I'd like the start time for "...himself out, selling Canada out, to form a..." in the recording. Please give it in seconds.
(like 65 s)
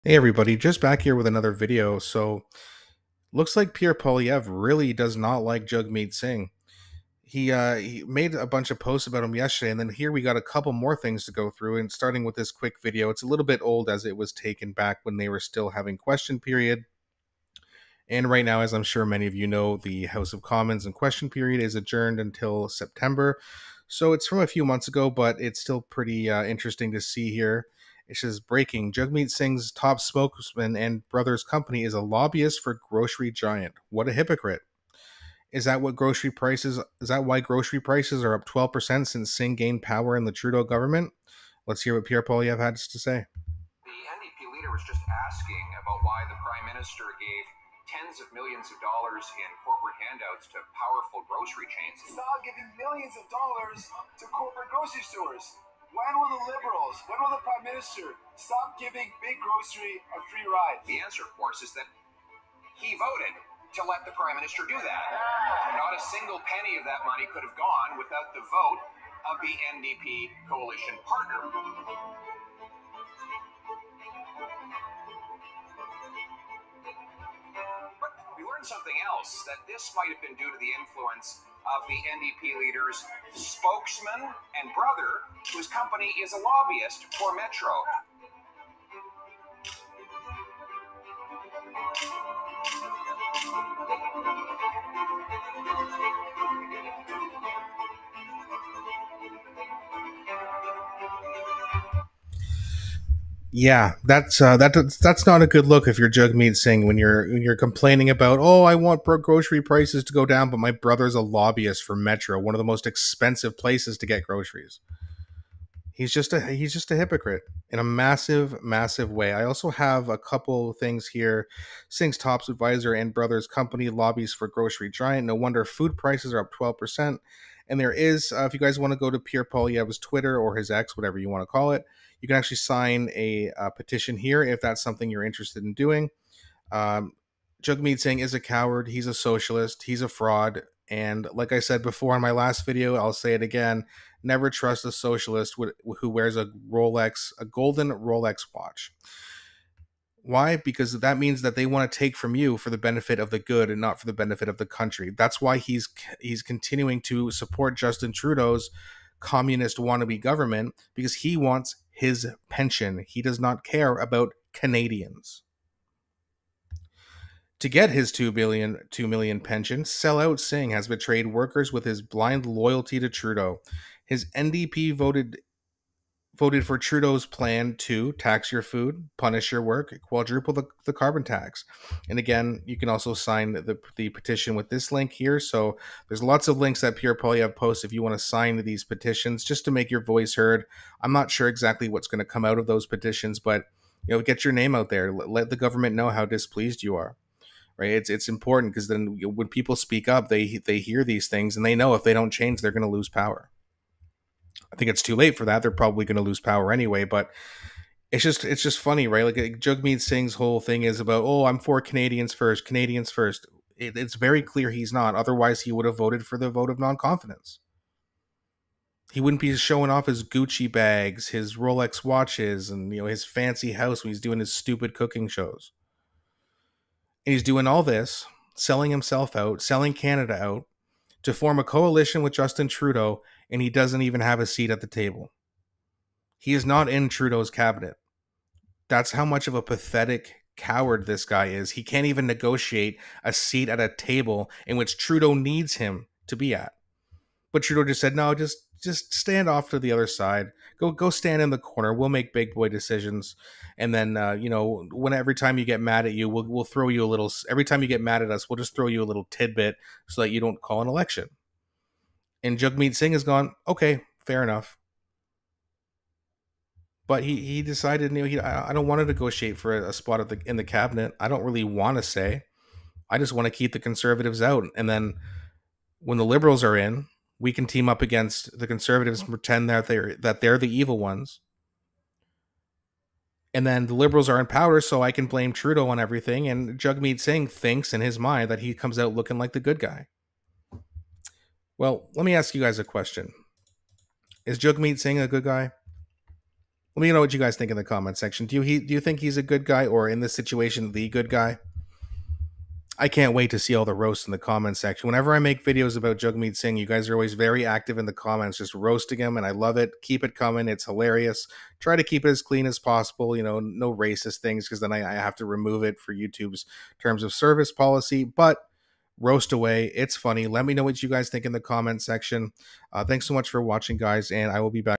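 228 s.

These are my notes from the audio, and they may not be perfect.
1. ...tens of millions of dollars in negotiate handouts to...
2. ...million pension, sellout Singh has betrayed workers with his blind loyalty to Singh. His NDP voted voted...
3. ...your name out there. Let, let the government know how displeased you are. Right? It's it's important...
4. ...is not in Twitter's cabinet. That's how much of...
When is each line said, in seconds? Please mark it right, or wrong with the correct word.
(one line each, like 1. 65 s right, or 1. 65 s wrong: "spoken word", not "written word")
1. 47 s wrong: "corporate", not "negotiate"
2. 169 s wrong: "Trudeau", not "Singh"
3. 194 s right
4. 236 s wrong: "Trudeau", not "Twitter".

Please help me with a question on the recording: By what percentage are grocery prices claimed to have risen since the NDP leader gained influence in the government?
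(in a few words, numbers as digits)
12%.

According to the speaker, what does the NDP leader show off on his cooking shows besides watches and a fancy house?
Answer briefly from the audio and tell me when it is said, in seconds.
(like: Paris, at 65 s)
Gucci bags, at 220 s.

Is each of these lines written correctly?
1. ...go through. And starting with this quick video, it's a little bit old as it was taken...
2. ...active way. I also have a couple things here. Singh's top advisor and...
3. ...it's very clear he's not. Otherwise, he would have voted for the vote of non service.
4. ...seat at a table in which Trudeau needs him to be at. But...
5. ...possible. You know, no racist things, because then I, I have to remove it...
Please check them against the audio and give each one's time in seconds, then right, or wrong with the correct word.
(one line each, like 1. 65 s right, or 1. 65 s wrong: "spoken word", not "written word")
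1. 11 s right
2. 118 s wrong: "massive", not "active"
3. 213 s wrong: "confidence", not "service"
4. 243 s right
5. 312 s right.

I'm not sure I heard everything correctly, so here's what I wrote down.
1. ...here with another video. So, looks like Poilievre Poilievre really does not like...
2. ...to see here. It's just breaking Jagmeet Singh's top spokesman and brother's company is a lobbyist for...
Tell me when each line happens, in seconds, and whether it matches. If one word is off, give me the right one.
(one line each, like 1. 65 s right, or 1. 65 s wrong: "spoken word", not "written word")
1. 1 s wrong: "Pierre", not "Poilievre"
2. 26 s right.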